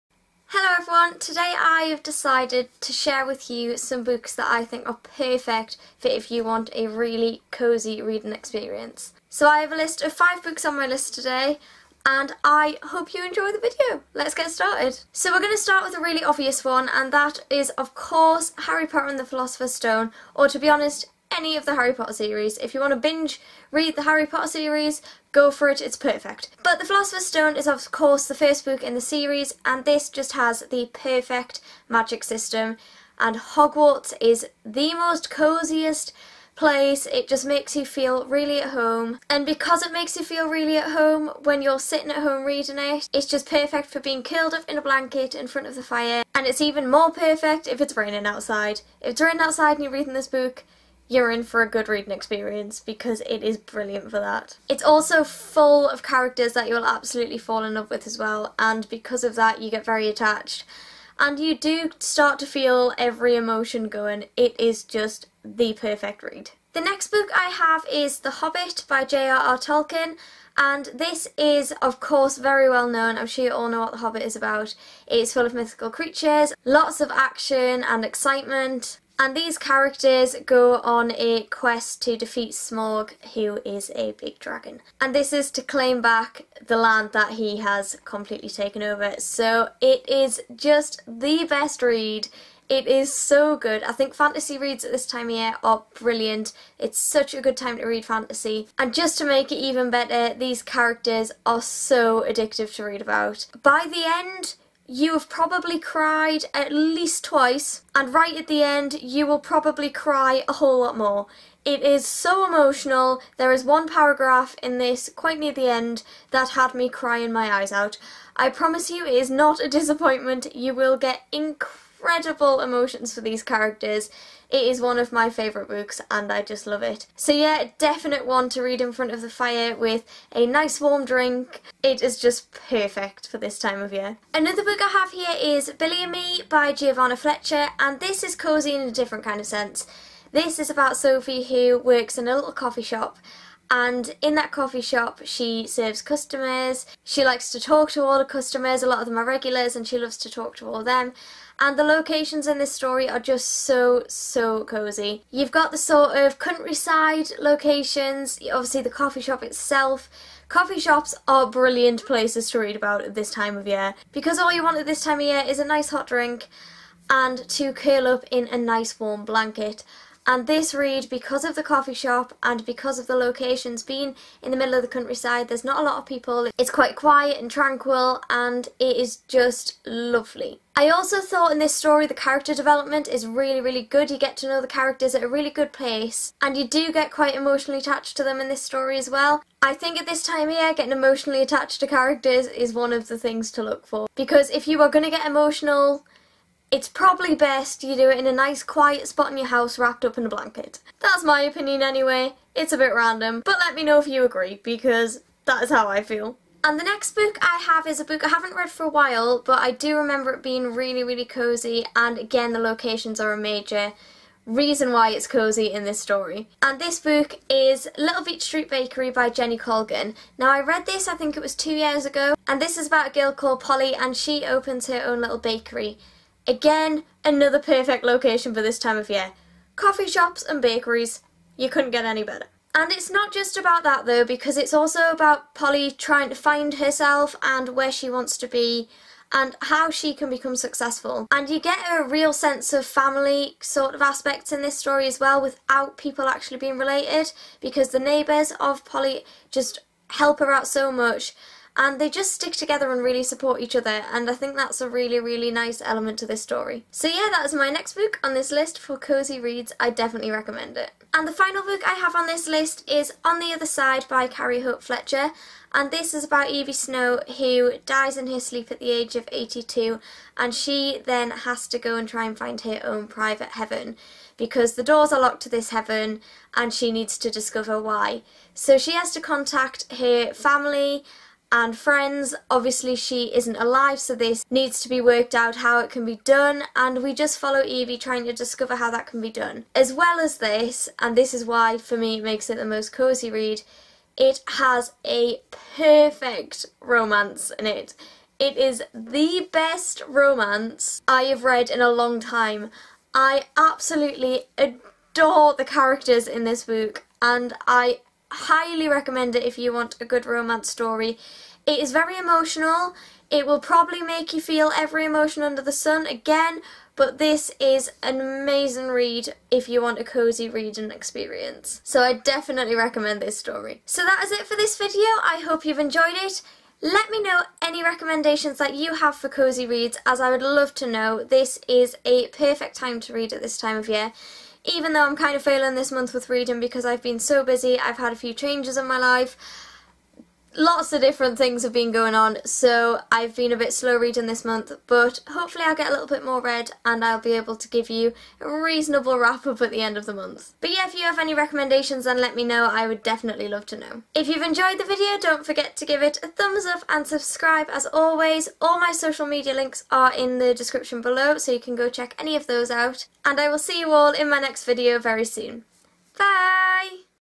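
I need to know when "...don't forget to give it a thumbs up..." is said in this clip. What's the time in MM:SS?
05:55.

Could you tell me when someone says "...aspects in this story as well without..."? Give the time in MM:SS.
04:04.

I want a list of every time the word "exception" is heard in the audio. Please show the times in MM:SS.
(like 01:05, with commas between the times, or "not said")
not said.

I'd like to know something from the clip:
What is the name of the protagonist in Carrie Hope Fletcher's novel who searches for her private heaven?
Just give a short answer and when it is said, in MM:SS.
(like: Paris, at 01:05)
Evie Snow, at 04:26.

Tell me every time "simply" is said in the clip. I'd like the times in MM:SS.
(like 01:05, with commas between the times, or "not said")
not said.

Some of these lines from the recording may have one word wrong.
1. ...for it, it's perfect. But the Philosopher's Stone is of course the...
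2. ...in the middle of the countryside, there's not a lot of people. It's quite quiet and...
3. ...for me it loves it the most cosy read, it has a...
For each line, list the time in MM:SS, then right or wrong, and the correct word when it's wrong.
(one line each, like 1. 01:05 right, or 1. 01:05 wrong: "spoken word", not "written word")
1. 00:25 right
2. 02:54 right
3. 04:51 wrong: "makes", not "loves".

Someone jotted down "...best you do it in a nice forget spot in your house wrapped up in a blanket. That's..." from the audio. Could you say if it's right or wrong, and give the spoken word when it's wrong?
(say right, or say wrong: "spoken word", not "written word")
wrong: "quiet", not "forget".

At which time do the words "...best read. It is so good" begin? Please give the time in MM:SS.
01:31.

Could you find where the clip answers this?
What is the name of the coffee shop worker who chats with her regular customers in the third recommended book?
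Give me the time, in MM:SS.
02:20.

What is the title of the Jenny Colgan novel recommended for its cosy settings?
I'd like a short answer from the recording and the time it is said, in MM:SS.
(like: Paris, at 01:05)
Little Beach Street Bakery, at 03:37.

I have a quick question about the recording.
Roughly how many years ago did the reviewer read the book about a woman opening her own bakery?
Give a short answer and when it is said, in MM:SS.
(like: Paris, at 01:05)
2, at 03:41.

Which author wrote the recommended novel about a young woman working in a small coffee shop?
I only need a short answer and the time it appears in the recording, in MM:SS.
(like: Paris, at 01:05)
Giovanna Fletcher, at 02:16.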